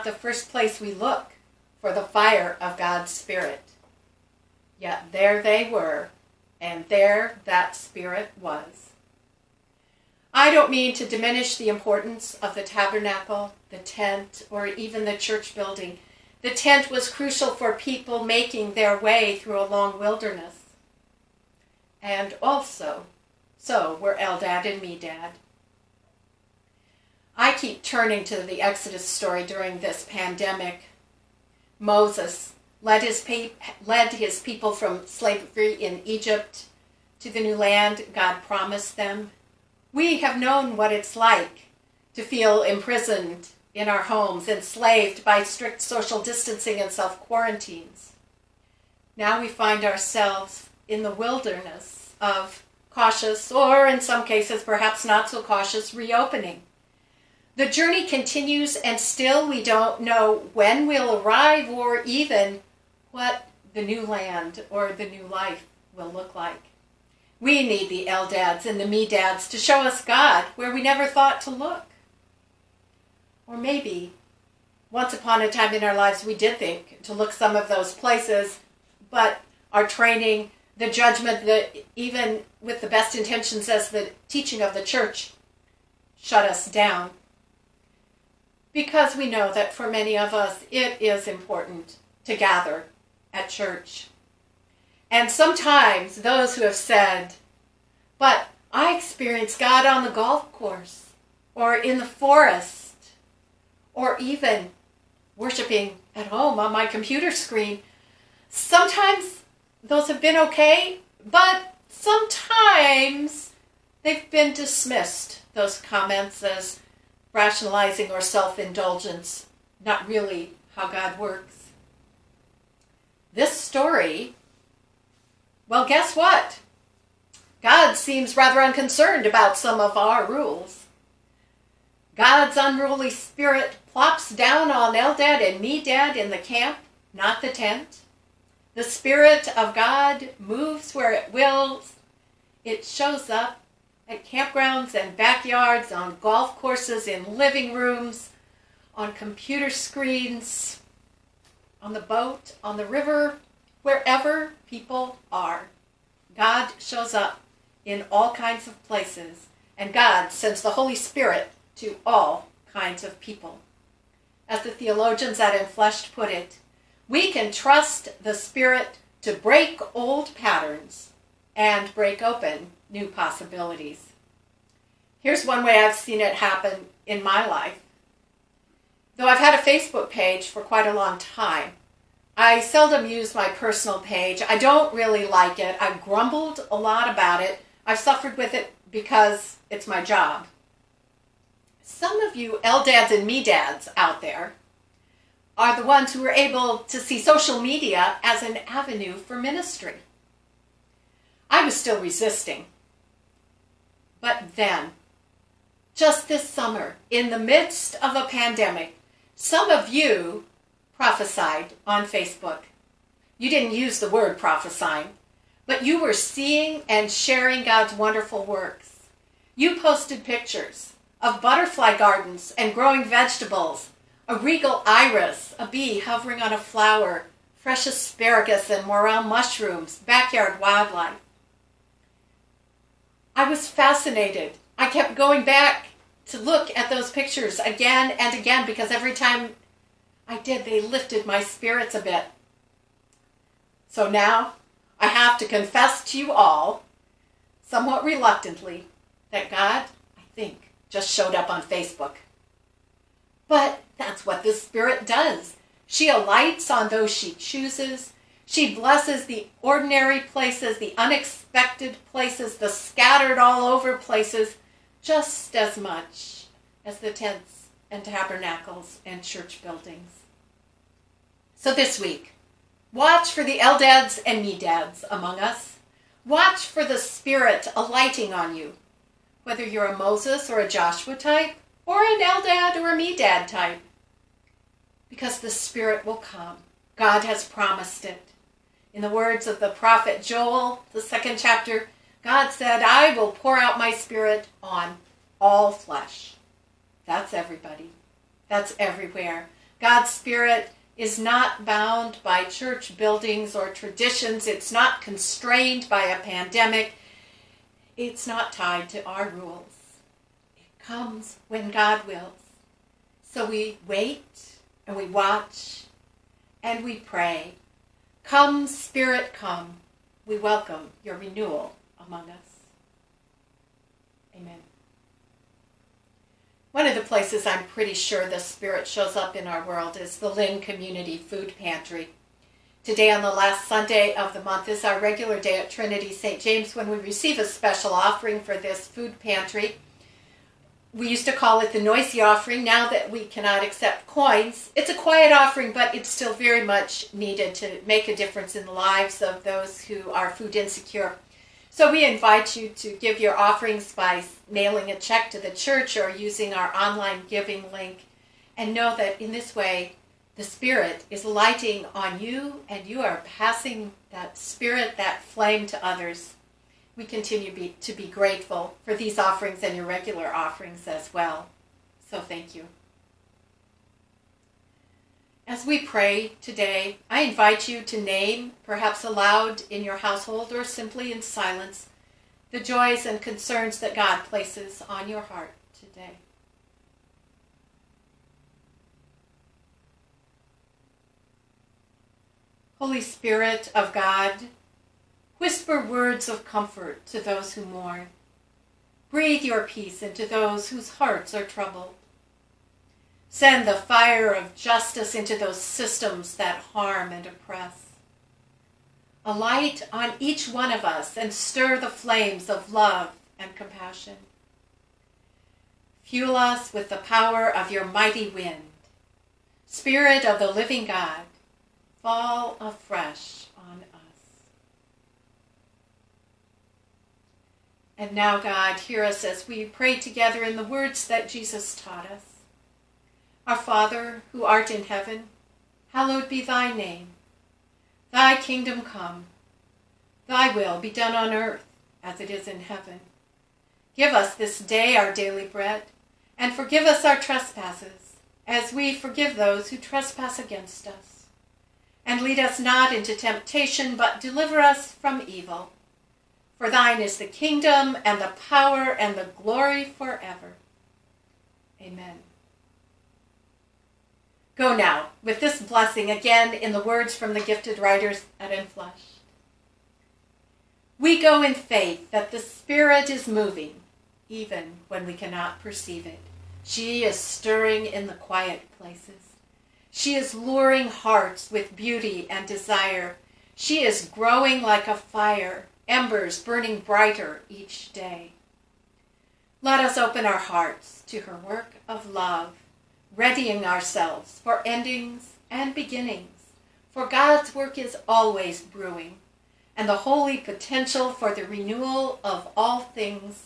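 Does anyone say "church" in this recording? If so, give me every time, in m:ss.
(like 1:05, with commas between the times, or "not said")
0:15, 1:24, 1:33, 4:29, 5:02, 5:55.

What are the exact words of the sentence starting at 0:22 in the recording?
And also, so were Eldad and Medad.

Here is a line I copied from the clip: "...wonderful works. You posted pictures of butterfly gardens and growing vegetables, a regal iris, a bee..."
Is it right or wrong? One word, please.
right.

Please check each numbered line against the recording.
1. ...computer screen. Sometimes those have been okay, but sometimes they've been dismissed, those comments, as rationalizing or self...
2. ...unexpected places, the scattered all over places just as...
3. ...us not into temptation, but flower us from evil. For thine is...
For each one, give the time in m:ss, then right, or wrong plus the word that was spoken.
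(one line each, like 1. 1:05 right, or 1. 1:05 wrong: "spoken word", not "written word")
1. 1:46 right
2. 4:20 right
3. 7:32 wrong: "deliver", not "flower".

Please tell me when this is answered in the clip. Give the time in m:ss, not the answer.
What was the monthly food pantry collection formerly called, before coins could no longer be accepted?
5:41.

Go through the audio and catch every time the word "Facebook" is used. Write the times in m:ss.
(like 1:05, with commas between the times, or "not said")
2:59, 3:32, 4:11.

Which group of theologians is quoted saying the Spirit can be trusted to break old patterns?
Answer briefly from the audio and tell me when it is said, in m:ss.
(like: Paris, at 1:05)
Enfleshed, at 2:45.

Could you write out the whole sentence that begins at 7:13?
Our Father, who art in heaven, hallowed be thy name.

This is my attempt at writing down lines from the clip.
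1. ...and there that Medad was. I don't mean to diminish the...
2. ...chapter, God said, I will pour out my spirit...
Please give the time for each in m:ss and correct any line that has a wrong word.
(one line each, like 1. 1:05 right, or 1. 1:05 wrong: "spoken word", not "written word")
1. 0:06 wrong: "Spirit", not "Medad"
2. 4:51 right.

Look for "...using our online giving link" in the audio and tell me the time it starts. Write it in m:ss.
5:56.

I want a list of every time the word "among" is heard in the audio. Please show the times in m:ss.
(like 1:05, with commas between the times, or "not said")
4:35, 5:22.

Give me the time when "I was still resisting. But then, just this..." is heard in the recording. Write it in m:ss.
3:21.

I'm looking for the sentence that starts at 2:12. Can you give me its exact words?
God's unruly spirit plops down on Eldad and Medad in the camp, not the tent.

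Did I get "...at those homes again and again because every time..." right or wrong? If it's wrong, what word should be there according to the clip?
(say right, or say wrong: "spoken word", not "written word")
wrong: "pictures", not "homes".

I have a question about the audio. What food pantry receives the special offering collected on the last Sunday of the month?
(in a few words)
Lynn Community Food Pantry.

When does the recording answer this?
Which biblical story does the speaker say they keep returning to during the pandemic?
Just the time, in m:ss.
0:28.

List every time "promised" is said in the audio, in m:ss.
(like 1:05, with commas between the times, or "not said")
0:38, 4:47.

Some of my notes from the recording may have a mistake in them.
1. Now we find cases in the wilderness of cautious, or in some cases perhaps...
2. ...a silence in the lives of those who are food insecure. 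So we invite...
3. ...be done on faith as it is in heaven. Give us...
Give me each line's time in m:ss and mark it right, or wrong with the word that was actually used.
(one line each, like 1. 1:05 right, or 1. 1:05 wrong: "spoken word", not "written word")
1. 0:49 wrong: "ourselves", not "cases"
2. 5:48 wrong: "difference", not "silence"
3. 7:20 wrong: "earth", not "faith".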